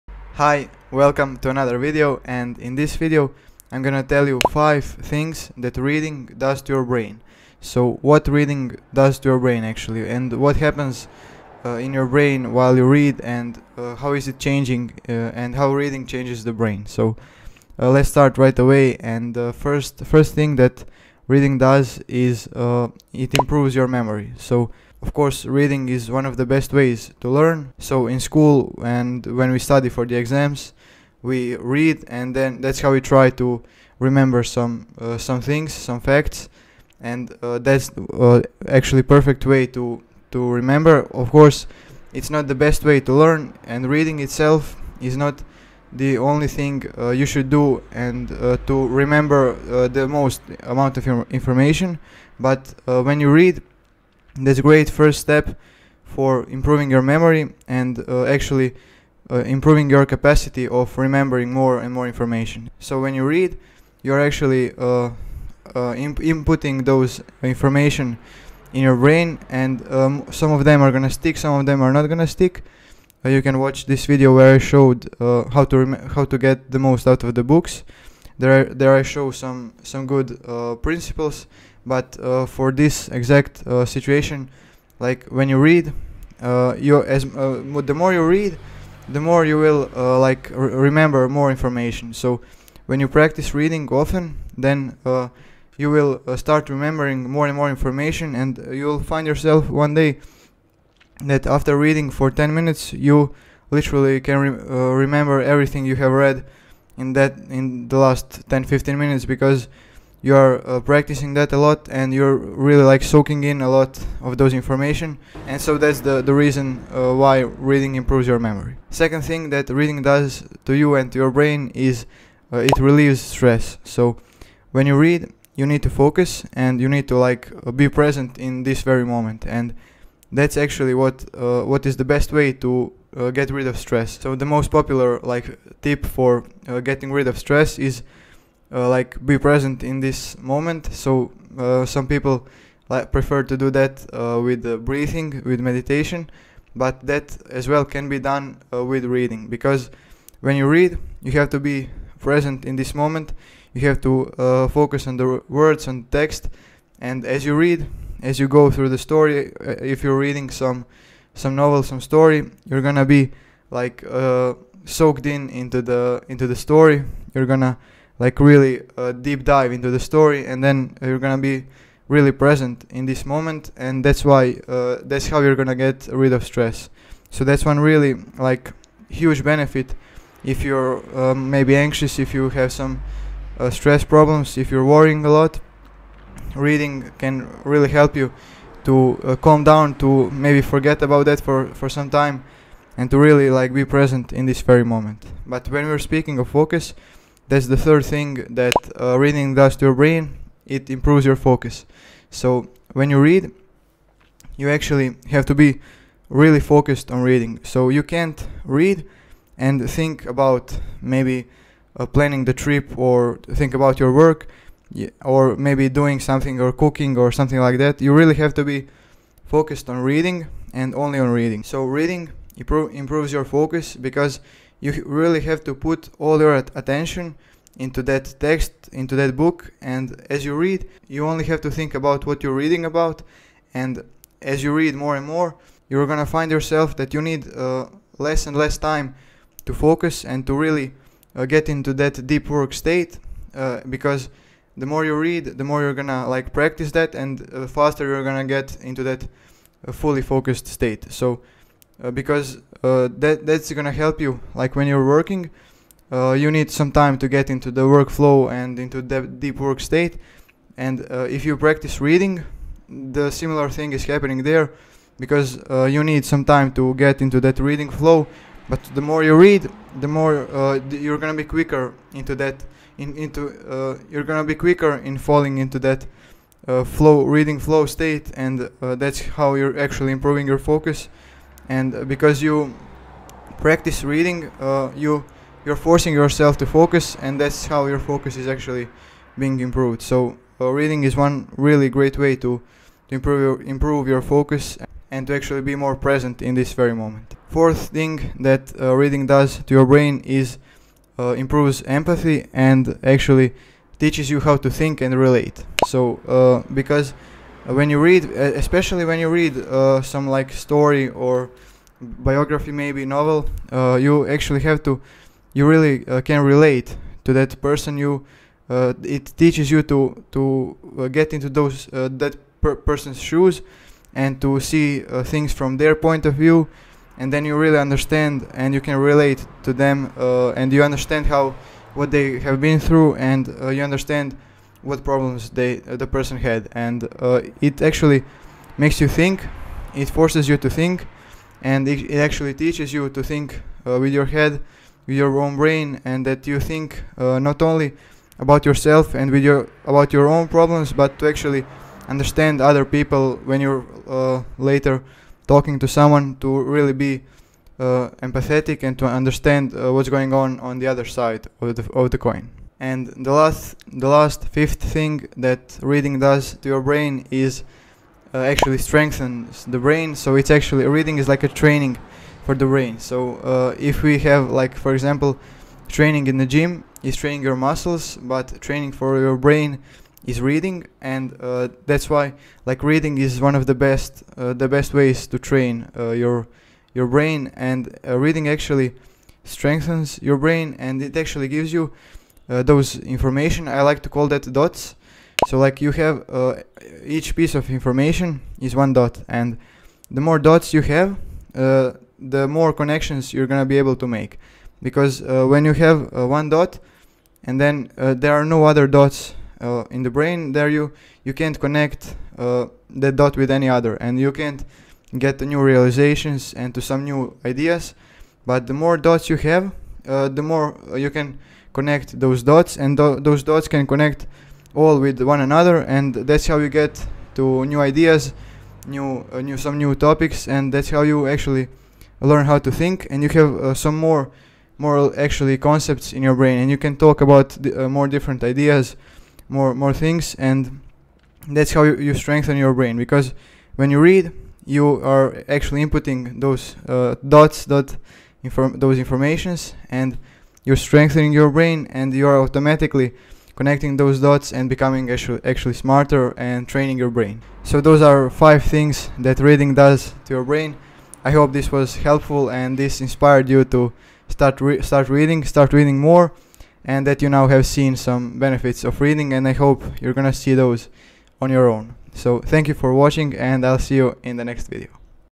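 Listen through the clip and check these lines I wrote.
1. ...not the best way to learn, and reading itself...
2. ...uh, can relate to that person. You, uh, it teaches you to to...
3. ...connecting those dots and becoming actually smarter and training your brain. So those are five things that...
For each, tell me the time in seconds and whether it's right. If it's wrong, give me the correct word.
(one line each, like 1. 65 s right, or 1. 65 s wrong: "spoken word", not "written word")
1. 42 s right
2. 316 s right
3. 453 s right.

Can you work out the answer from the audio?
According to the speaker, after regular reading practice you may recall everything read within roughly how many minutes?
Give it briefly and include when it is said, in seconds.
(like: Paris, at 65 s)
10 minutes, at 102 s.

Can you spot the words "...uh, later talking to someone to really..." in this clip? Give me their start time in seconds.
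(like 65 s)
354 s.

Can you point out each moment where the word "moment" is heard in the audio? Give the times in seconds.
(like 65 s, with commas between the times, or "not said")
129 s, 140 s, 152 s, 173 s, 194 s, 296 s.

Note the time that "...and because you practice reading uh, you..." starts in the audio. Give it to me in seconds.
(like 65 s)
281 s.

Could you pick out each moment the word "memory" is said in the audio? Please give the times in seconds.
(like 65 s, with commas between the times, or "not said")
23 s, 57 s, 118 s.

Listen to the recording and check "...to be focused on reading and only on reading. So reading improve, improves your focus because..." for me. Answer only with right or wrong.
right.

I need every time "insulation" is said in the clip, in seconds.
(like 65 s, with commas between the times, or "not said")
not said.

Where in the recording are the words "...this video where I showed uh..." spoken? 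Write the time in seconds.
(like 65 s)
73 s.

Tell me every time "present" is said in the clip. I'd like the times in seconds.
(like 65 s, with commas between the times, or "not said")
127 s, 139 s, 152 s, 172 s, 193 s, 295 s.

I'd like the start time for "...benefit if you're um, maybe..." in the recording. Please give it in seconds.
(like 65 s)
179 s.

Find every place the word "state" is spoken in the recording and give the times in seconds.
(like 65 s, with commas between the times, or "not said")
242 s, 250 s, 259 s, 277 s.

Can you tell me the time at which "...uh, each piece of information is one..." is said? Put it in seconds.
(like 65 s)
396 s.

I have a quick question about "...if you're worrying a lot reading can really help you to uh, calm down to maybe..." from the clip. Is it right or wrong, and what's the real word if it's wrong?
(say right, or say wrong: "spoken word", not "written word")
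right.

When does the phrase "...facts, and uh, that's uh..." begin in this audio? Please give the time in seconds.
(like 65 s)
36 s.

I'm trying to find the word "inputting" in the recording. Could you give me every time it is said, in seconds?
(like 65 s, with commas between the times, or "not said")
66 s, 445 s.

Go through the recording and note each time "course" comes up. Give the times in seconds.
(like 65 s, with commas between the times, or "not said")
25 s, 41 s.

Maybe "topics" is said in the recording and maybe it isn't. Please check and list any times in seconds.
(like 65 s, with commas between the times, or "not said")
429 s.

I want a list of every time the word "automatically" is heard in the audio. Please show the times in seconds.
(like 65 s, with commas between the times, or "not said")
452 s.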